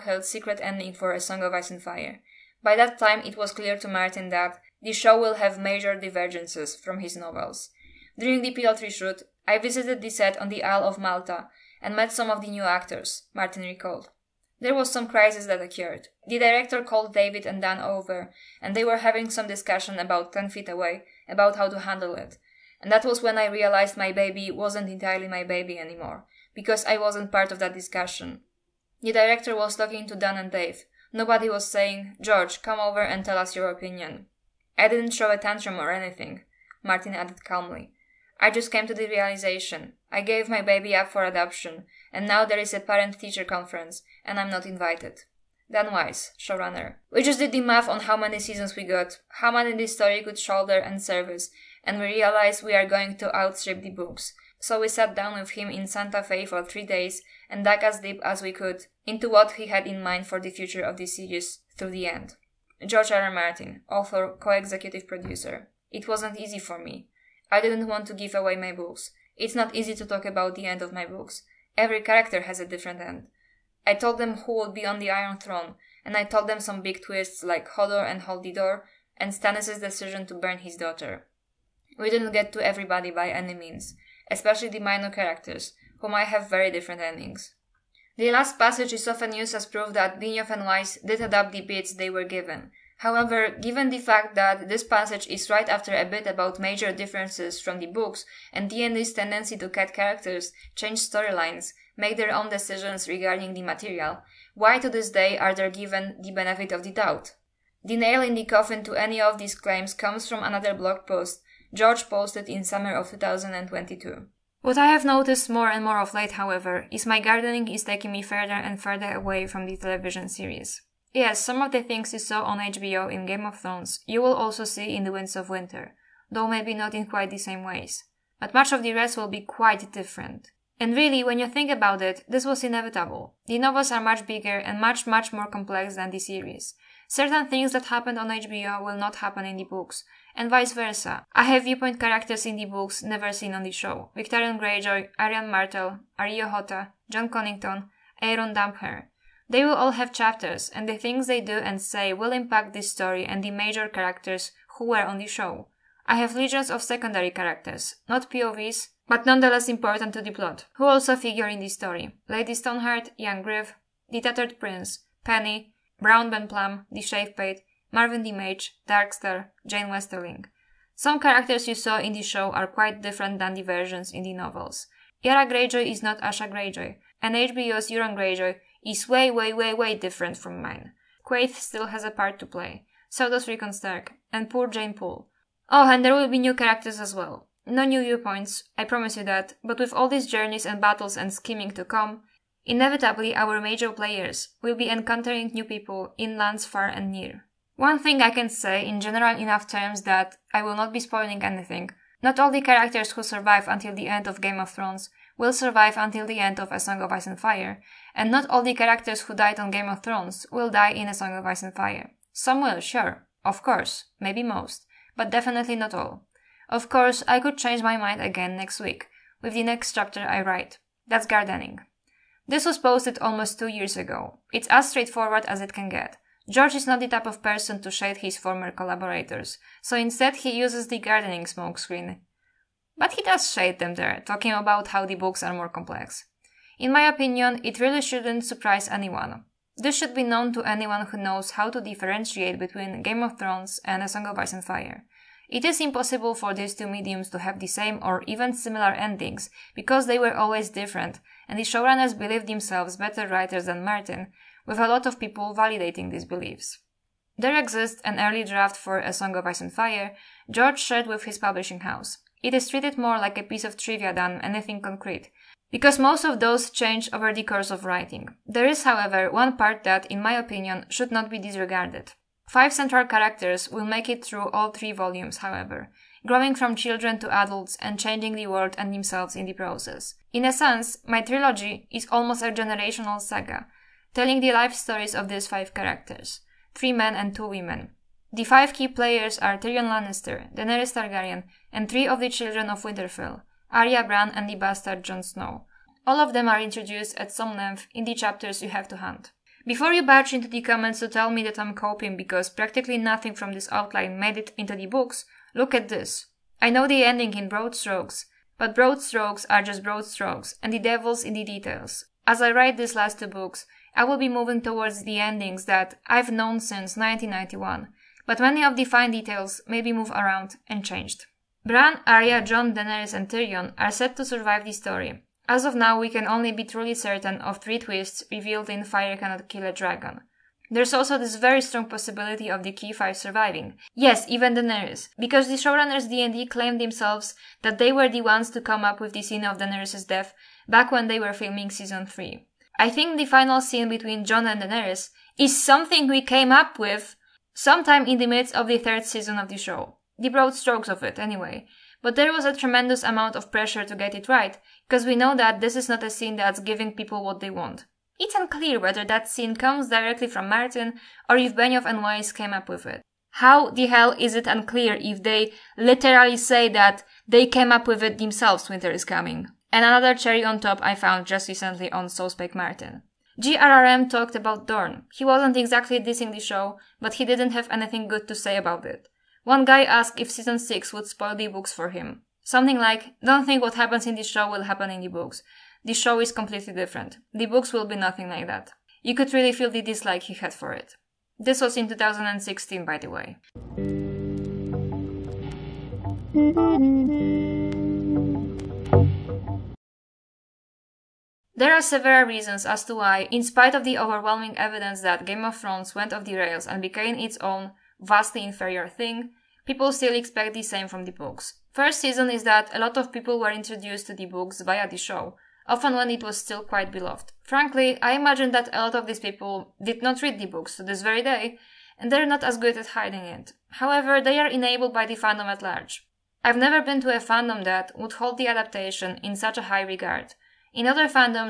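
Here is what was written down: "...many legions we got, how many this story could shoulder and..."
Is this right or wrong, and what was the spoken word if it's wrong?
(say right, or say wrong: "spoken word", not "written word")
wrong: "seasons", not "legions".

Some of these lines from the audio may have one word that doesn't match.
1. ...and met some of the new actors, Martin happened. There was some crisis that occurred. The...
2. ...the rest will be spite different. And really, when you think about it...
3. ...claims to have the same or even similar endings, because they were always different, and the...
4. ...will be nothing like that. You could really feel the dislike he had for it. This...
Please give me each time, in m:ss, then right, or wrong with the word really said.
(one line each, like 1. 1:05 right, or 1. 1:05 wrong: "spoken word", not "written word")
1. 0:11 wrong: "recalled", not "happened"
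2. 2:08 wrong: "quite", not "spite"
3. 4:06 wrong: "mediums", not "claims"
4. 6:27 right.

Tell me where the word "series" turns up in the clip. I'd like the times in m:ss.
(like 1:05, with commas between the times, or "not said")
1:01, 2:00, 2:16.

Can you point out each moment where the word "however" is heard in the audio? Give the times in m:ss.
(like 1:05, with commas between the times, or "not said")
1:32, 1:56, 4:28, 4:35, 7:03.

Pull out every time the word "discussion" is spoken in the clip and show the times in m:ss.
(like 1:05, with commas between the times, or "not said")
0:19, 0:27.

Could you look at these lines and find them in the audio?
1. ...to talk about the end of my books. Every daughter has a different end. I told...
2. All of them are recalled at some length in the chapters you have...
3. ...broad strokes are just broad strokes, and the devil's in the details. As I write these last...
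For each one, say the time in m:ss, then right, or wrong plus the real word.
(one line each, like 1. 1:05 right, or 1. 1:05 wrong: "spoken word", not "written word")
1. 1:09 wrong: "character", not "daughter"
2. 4:56 wrong: "introduced", not "recalled"
3. 5:08 right.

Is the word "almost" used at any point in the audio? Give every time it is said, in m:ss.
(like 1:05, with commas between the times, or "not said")
3:43, 4:42.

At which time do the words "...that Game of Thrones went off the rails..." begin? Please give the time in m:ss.
6:45.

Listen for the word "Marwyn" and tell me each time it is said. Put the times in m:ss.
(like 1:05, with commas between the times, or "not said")
2:47.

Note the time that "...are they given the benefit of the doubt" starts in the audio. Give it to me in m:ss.
1:45.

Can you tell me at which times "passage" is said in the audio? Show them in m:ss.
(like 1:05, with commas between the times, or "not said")
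1:28, 1:34.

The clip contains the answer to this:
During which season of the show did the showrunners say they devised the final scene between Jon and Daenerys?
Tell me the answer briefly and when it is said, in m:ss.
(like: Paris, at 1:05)
Third season, at 5:48.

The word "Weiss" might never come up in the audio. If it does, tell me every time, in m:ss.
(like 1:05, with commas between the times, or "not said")
0:45, 1:30, 6:02.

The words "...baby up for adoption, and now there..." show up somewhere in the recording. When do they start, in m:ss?
0:40.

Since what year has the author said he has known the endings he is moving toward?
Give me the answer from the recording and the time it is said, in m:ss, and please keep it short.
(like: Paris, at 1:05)
1991, at 5:16.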